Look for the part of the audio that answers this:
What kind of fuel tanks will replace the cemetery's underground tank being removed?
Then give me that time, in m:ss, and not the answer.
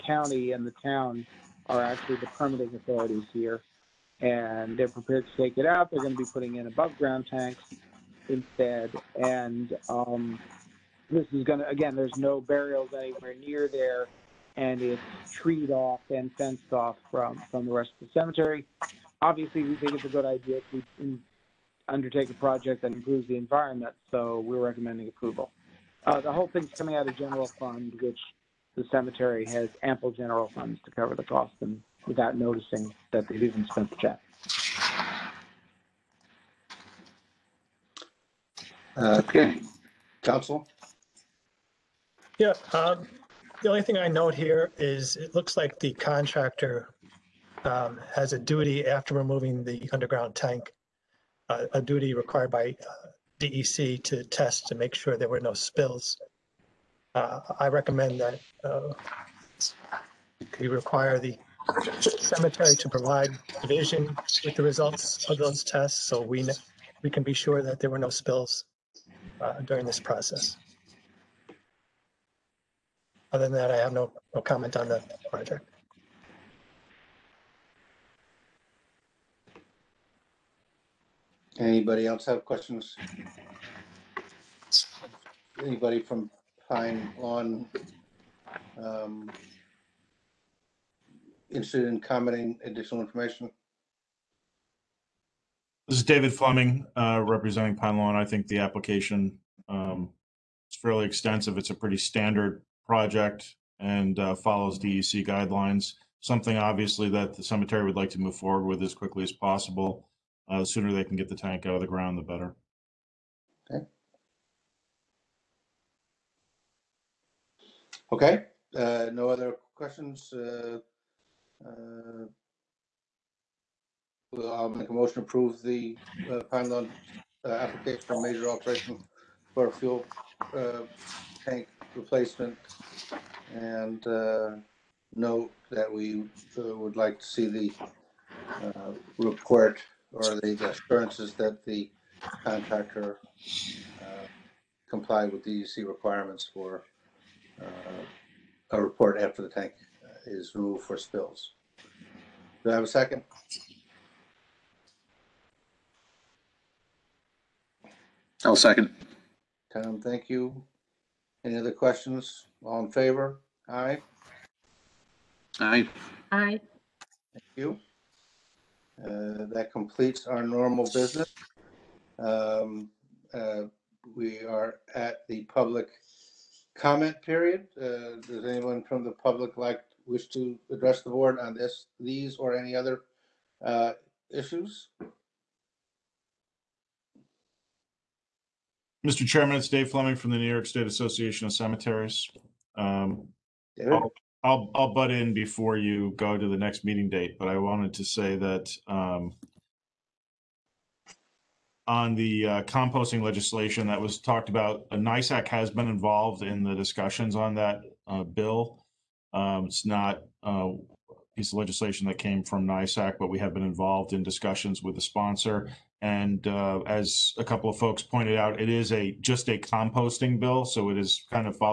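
0:06.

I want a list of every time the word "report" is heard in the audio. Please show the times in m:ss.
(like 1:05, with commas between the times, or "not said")
2:19, 2:28.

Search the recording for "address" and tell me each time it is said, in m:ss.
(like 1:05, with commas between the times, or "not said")
3:00.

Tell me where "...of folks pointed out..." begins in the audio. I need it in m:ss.
3:37.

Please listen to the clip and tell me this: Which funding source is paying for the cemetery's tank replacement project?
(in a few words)
General fund.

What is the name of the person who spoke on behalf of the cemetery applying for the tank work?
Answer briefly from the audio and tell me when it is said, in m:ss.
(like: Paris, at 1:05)
David Fleming, at 1:36.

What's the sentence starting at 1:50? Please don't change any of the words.
Uh, the sooner they can get the tank out of the ground, the better.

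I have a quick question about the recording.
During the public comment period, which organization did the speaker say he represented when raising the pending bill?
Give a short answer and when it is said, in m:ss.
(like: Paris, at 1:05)
New York State Association of Cemeteries, at 3:10.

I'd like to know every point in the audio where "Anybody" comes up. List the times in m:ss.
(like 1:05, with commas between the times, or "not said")
1:21, 1:25.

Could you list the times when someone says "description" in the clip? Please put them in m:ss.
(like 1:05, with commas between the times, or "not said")
not said.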